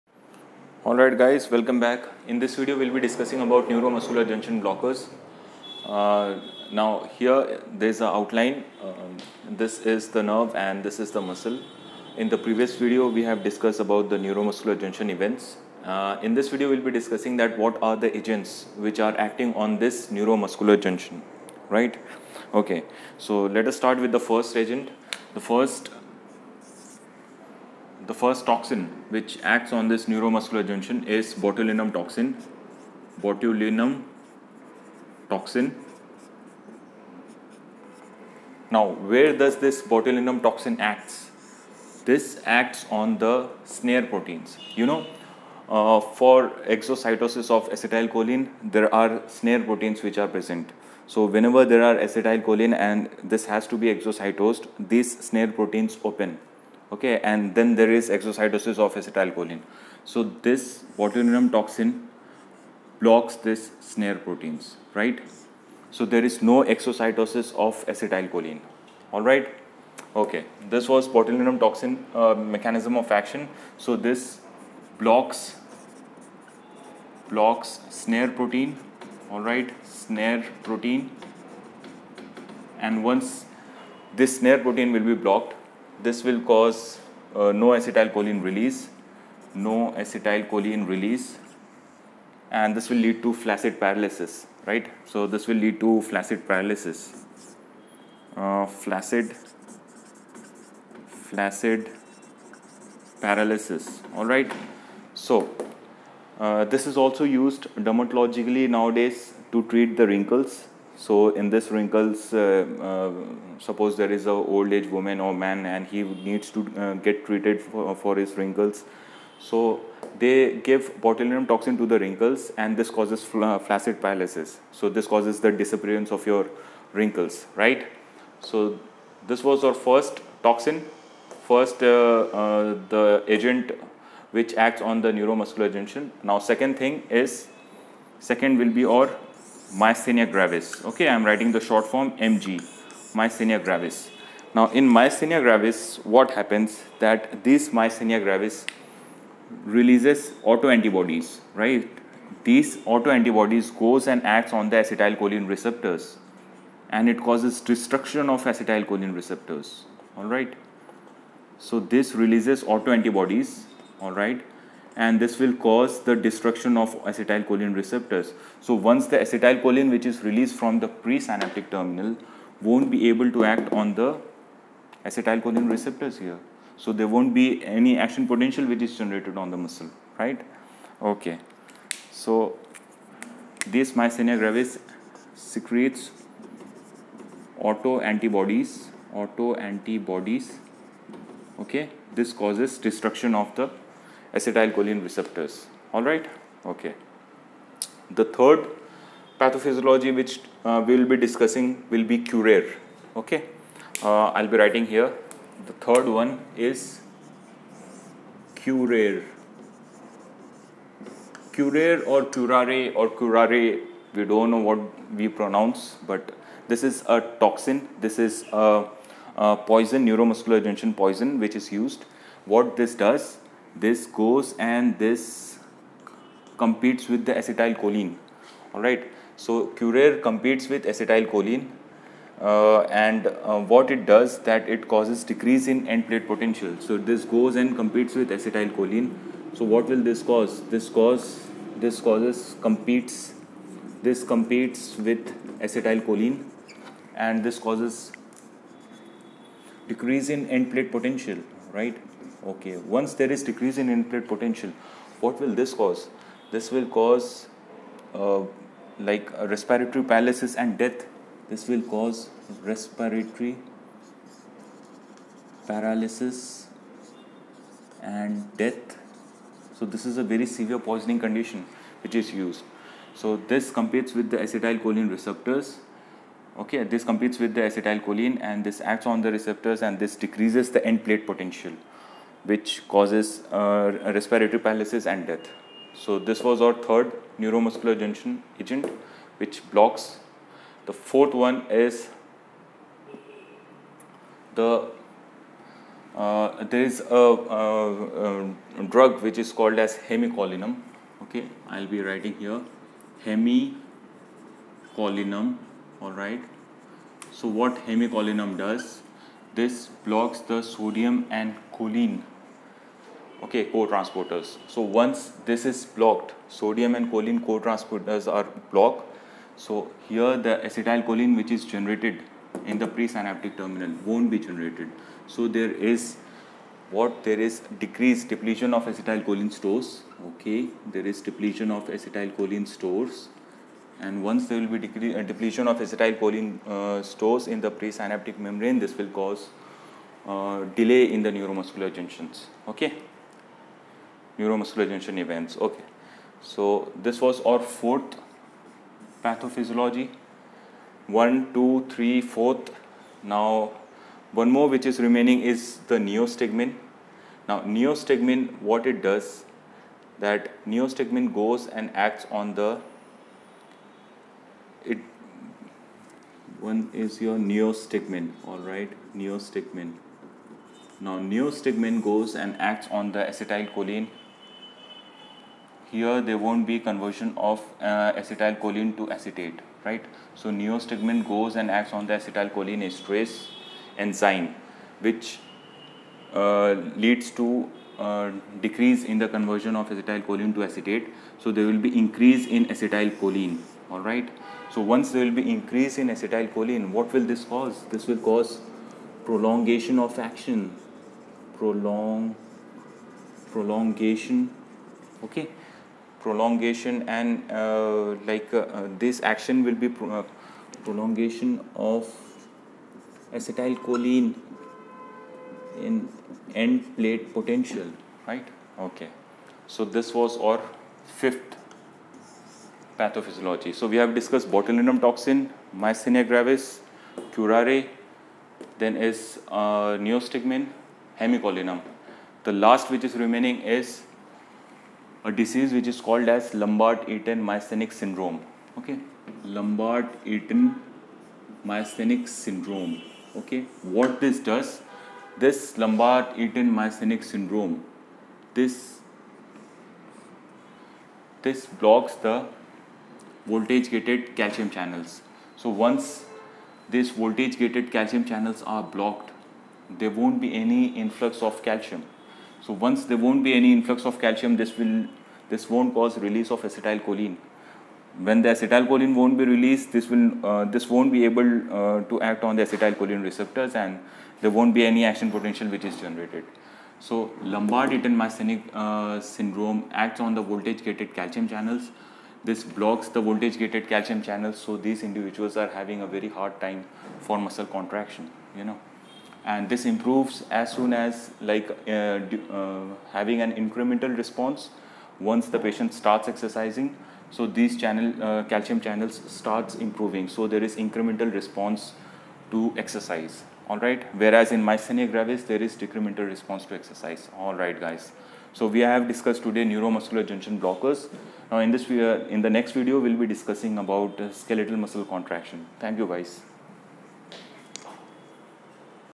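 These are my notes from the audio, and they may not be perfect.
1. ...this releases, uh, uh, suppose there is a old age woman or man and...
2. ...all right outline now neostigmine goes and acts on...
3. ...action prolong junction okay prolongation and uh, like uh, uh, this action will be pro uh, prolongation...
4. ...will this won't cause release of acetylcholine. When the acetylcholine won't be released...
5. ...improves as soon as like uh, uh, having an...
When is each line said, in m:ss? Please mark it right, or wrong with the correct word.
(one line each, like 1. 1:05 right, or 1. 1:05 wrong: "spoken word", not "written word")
1. 1:51 wrong: "wrinkles", not "releases"
2. 6:08 wrong: "neostigmine", not "outline"
3. 6:40 wrong: "prolongation", not "junction"
4. 7:44 right
5. 8:09 right.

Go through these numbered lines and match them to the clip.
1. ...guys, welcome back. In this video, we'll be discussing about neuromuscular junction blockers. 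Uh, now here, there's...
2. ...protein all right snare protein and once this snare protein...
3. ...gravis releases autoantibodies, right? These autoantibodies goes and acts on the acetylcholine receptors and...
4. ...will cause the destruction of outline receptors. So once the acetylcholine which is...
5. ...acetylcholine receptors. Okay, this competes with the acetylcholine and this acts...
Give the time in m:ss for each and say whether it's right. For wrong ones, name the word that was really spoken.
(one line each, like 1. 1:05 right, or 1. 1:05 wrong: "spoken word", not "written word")
1. 0:01 right
2. 1:18 right
3. 2:28 right
4. 2:45 wrong: "acetylcholine", not "outline"
5. 4:34 right.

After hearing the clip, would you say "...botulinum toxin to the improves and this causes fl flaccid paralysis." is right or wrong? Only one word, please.
wrong.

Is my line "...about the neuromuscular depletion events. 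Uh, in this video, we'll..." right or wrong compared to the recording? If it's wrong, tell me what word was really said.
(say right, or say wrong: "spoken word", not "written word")
wrong: "junction", not "depletion".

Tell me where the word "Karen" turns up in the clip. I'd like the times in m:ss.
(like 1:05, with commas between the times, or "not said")
not said.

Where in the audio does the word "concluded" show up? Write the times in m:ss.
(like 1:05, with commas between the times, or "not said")
not said.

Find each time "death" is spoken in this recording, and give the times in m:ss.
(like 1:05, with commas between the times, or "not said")
4:20, 4:28, 4:45.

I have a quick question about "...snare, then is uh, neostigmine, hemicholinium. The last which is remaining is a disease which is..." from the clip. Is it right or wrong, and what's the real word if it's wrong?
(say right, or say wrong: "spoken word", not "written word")
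wrong: "curare", not "snare".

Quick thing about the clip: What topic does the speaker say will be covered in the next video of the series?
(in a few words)
Skeletal muscle contraction.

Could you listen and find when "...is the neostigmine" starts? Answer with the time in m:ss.
5:55.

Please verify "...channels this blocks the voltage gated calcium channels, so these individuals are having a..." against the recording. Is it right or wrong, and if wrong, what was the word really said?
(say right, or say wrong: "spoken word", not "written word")
right.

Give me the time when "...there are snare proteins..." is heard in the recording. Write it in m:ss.
0:48.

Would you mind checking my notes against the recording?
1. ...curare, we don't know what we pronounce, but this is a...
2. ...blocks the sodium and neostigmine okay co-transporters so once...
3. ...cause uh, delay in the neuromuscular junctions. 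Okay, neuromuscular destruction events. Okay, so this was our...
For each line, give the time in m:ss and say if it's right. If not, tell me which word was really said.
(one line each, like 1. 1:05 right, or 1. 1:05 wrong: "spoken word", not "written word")
1. 3:33 right
2. 5:10 wrong: "choline", not "neostigmine"
3. 5:39 wrong: "junction", not "destruction".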